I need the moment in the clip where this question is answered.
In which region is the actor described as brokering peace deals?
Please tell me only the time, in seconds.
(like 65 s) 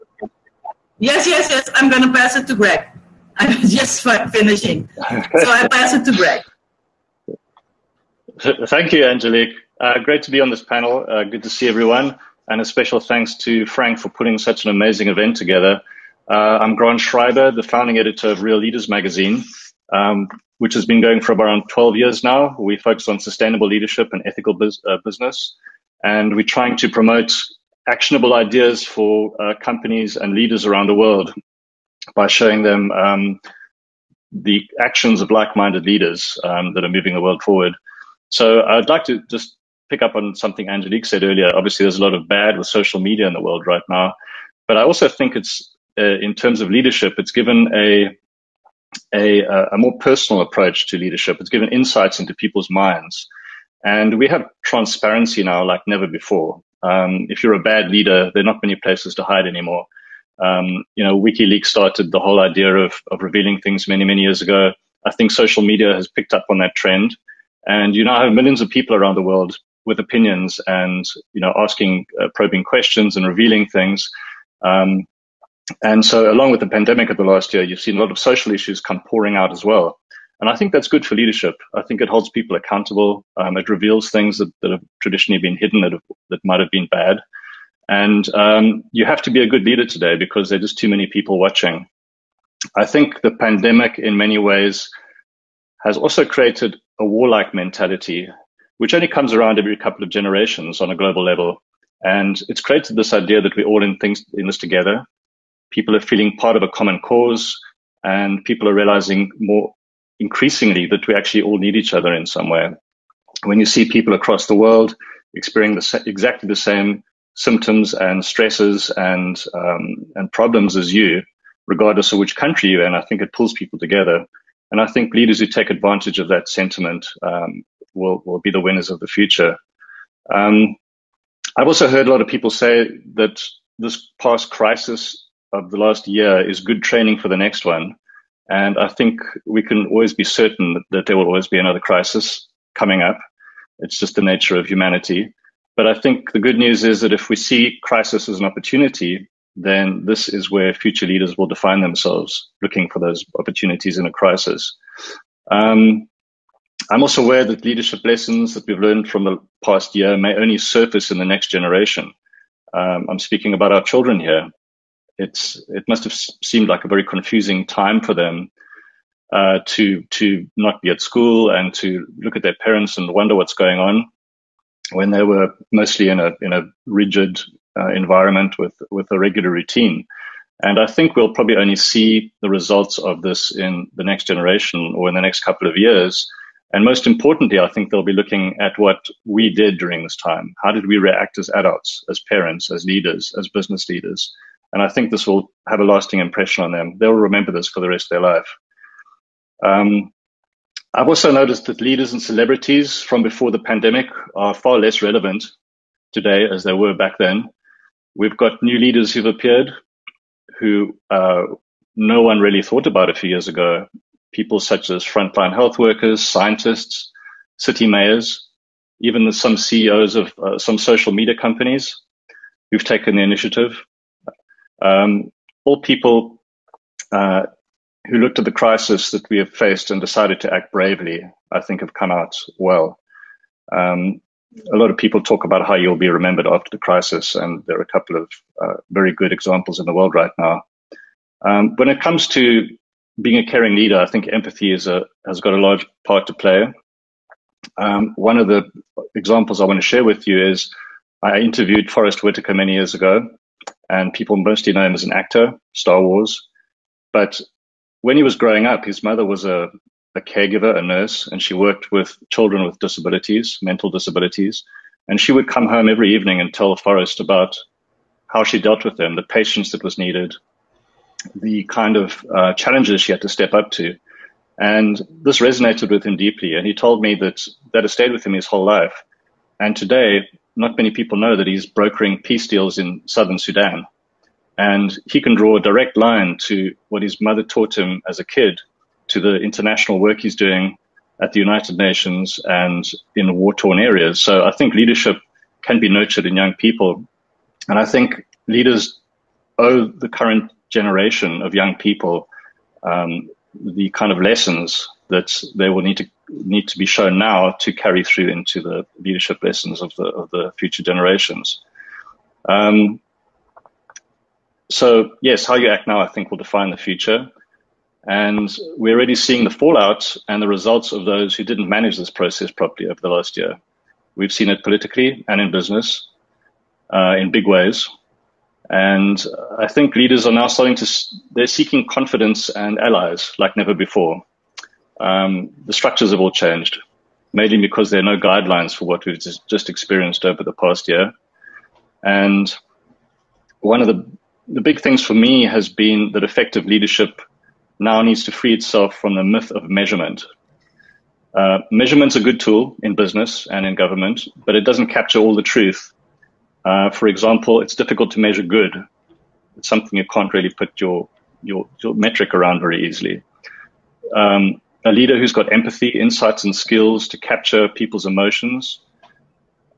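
283 s.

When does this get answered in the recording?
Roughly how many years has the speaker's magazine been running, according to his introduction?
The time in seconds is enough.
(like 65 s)
21 s.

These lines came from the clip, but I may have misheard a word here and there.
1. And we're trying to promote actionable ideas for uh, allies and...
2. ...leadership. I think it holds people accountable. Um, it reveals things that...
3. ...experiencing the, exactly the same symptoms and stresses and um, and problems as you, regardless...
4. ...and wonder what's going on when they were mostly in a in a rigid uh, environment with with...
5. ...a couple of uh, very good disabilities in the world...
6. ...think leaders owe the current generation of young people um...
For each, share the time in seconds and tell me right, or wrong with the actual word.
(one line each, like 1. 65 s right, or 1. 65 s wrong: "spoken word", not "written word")
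1. 26 s wrong: "companies", not "allies"
2. 81 s right
3. 115 s right
4. 172 s right
5. 237 s wrong: "examples", not "disabilities"
6. 297 s right.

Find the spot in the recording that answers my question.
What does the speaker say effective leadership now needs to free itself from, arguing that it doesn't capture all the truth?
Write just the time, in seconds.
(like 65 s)
349 s.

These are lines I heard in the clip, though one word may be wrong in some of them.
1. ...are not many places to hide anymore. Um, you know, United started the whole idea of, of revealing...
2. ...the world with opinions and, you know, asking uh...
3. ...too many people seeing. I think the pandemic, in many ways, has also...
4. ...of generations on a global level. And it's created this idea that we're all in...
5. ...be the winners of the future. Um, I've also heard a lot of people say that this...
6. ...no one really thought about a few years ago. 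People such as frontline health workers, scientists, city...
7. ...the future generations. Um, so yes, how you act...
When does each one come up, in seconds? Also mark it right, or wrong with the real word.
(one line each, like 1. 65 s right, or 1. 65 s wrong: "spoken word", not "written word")
1. 58 s wrong: "WikiLeaks", not "United"
2. 69 s right
3. 90 s wrong: "watching", not "seeing"
4. 100 s right
5. 128 s right
6. 211 s right
7. 310 s right.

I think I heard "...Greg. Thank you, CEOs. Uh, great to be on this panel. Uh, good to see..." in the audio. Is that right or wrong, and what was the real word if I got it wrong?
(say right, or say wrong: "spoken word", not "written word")
wrong: "Angelic", not "CEOs".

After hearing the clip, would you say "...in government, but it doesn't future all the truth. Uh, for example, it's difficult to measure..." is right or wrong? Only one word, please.
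wrong.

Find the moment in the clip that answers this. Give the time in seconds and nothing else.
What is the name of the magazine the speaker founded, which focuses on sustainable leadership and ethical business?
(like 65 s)
18 s.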